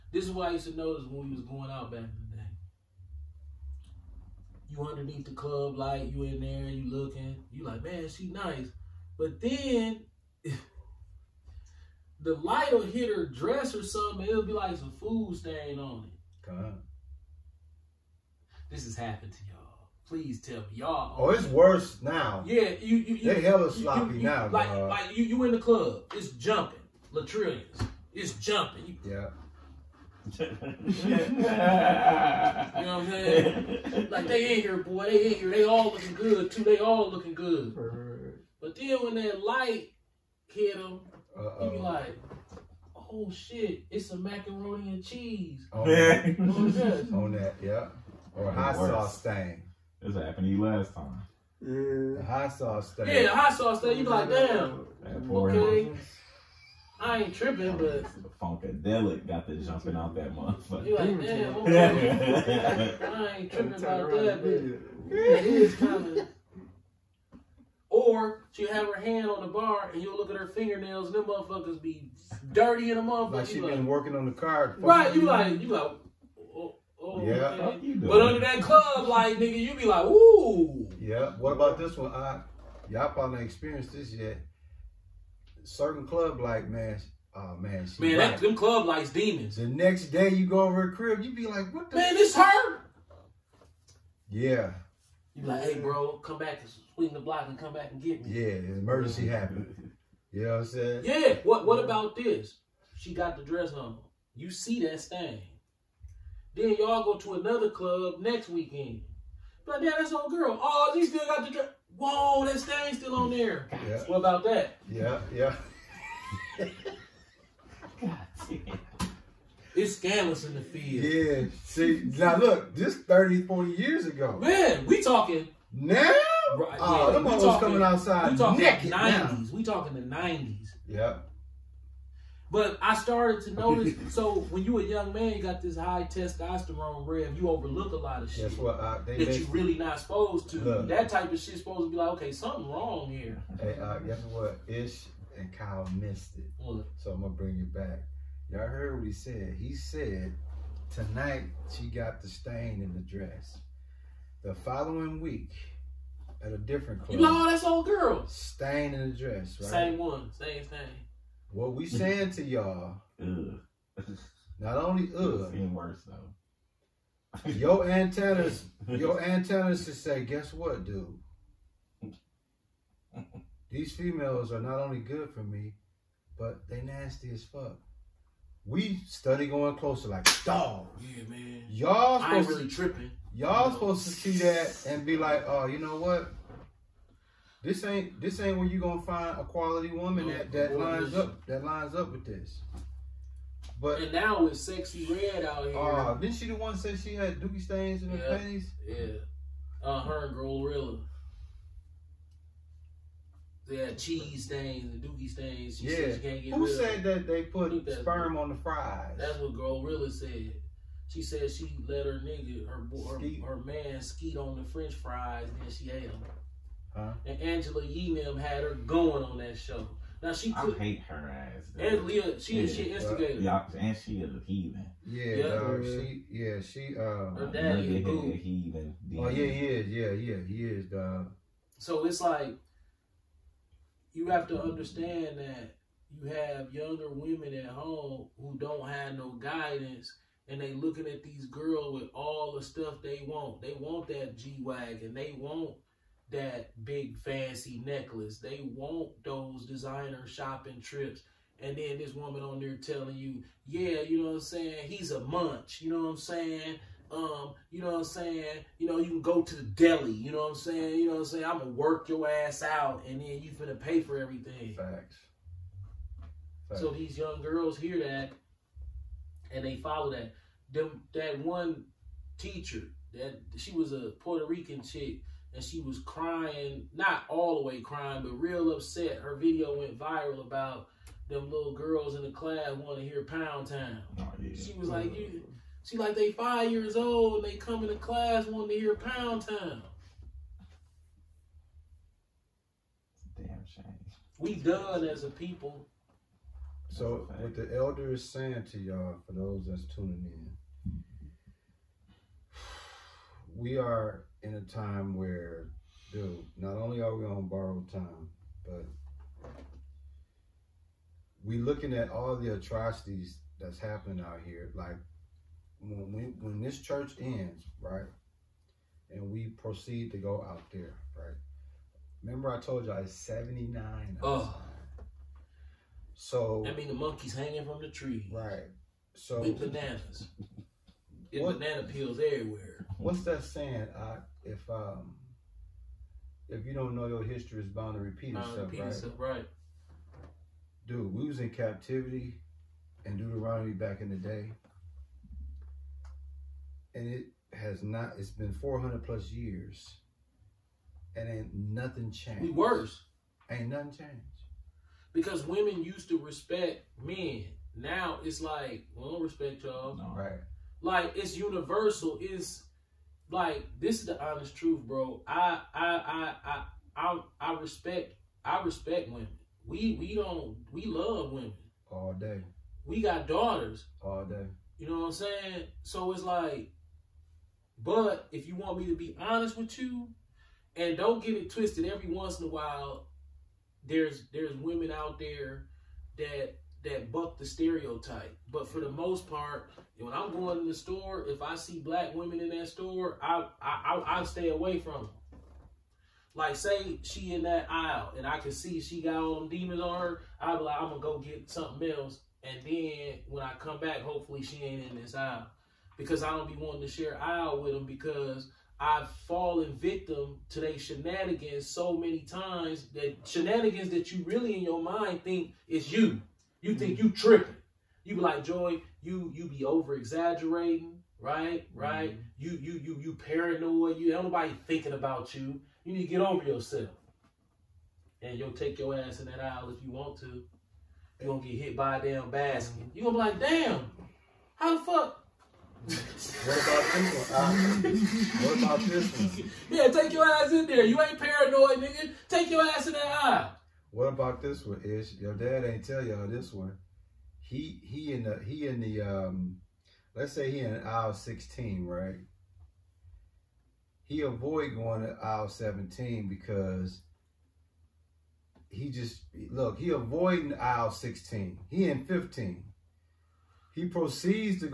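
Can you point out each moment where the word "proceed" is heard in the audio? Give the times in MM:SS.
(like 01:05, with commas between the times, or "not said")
05:19, 07:43.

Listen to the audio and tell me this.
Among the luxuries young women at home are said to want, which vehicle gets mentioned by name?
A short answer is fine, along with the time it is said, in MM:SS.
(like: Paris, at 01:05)
G Wagon, at 04:04.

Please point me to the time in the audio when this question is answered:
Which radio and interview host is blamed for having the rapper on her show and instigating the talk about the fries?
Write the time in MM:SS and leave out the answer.
03:37.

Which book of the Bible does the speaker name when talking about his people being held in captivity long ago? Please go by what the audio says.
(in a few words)
Deuteronomy.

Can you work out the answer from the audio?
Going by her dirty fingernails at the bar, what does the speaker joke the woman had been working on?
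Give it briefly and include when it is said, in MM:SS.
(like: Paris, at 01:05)
The car, at 01:14.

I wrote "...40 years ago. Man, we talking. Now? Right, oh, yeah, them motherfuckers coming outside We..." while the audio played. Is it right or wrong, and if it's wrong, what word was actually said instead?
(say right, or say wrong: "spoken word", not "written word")
right.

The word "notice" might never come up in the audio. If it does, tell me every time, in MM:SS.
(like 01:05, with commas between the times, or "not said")
00:00, 02:13.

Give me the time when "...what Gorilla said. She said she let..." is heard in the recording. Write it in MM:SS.
03:29.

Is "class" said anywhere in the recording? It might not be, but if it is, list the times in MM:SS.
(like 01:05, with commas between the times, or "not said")
04:42, 04:47.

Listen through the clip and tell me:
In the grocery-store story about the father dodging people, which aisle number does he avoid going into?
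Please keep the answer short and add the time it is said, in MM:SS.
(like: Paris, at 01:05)
17, at 07:35.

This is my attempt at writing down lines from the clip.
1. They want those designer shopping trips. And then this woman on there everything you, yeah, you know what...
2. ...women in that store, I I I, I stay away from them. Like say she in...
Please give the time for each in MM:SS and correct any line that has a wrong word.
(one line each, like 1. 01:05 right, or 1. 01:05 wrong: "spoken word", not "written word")
1. 04:08 wrong: "telling", not "everything"
2. 06:32 right.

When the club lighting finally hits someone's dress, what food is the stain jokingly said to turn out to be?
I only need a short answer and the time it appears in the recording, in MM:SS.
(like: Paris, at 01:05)
Macaroni and cheese, at 00:44.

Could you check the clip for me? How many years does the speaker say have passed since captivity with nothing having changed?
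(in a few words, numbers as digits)
400 plus.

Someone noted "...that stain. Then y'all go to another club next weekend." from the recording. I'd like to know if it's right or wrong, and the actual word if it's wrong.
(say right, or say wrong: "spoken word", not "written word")
right.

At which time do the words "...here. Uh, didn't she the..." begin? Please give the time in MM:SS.
03:15.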